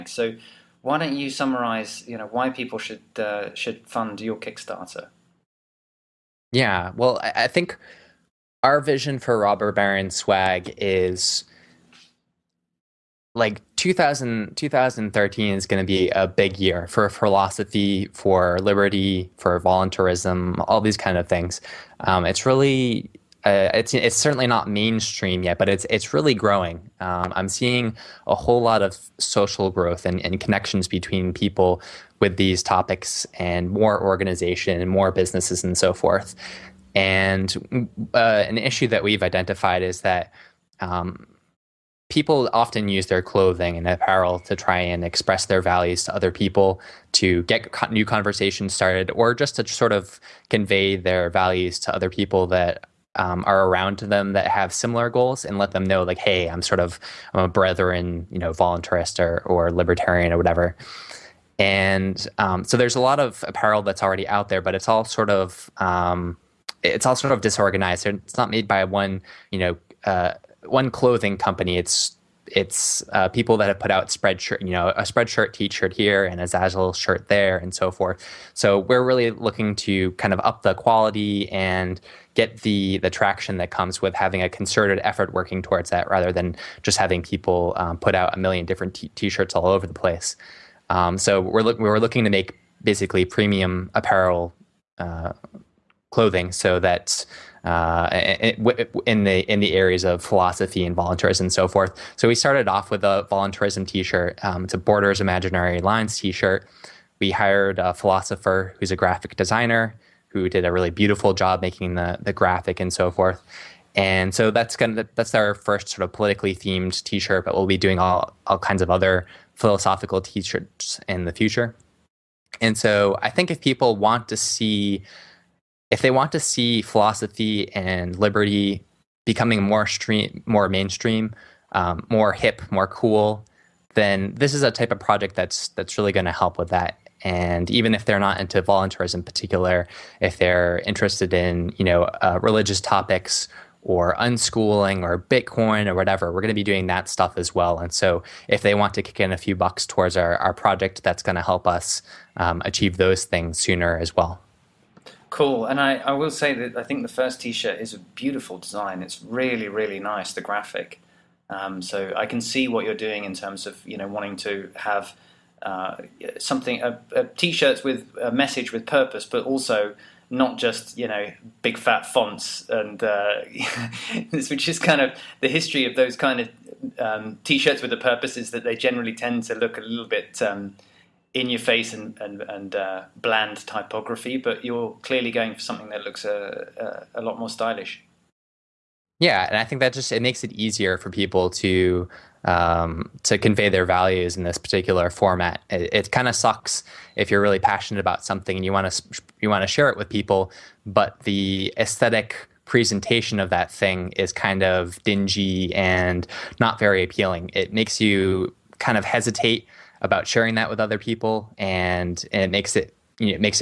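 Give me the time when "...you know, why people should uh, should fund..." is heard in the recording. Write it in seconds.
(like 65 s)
2 s.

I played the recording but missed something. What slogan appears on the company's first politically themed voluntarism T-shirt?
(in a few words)
Borders Imaginary Lines.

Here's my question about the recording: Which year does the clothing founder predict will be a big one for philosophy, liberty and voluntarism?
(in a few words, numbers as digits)
2013.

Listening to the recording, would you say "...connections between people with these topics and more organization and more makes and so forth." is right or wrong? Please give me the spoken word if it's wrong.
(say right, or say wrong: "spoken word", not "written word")
wrong: "businesses", not "makes".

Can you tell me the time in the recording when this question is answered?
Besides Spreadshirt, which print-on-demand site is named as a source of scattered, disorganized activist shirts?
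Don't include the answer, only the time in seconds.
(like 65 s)
76 s.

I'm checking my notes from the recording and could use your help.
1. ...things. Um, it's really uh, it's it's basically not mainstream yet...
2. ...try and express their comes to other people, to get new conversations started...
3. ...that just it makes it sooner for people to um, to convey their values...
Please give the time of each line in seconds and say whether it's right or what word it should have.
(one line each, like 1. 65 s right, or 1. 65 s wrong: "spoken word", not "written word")
1. 21 s wrong: "certainly", not "basically"
2. 44 s wrong: "values", not "comes"
3. 189 s wrong: "easier", not "sooner".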